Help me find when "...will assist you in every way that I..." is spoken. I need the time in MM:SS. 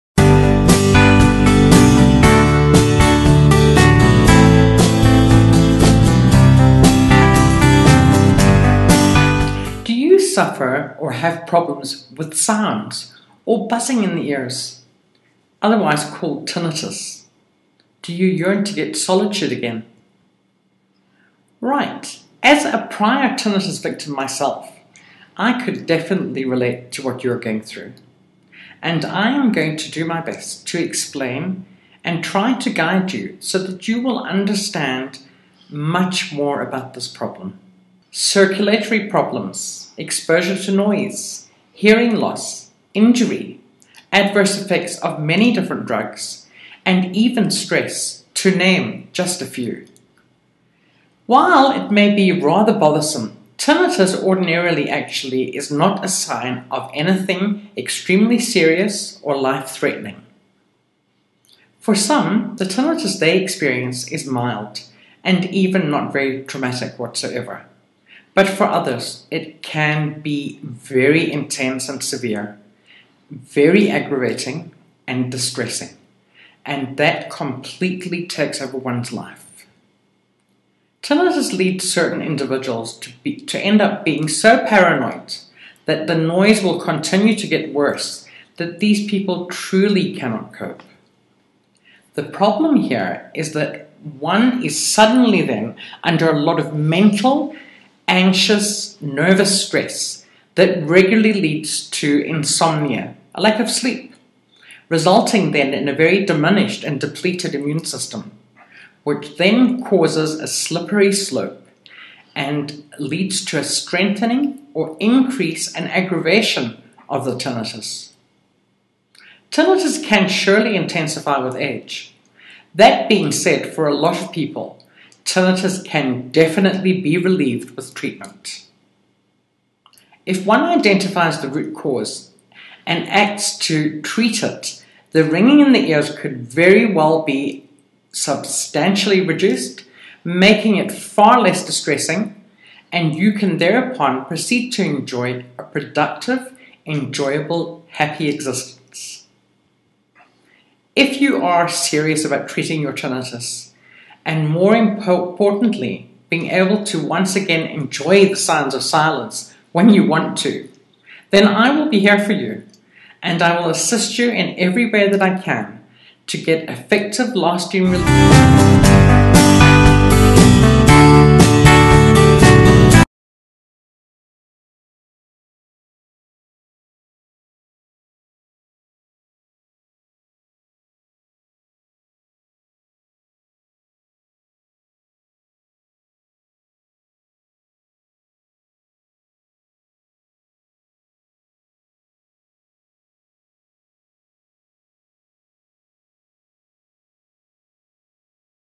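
02:43.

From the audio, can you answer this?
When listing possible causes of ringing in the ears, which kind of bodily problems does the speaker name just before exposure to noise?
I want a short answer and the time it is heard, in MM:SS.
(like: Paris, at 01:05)
circulatory problems, at 00:38.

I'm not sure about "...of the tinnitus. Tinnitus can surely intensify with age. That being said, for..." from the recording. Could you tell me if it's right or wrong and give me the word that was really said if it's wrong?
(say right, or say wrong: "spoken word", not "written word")
right.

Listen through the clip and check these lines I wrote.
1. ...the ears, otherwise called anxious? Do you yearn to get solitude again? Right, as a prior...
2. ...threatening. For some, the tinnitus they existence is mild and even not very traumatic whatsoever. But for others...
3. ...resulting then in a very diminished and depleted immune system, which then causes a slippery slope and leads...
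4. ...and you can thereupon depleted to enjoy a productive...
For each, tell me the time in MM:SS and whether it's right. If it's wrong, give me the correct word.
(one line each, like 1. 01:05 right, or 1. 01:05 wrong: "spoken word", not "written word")
1. 00:14 wrong: "tinnitus", not "anxious"
2. 00:59 wrong: "experience", not "existence"
3. 01:44 right
4. 02:22 wrong: "proceed", not "depleted".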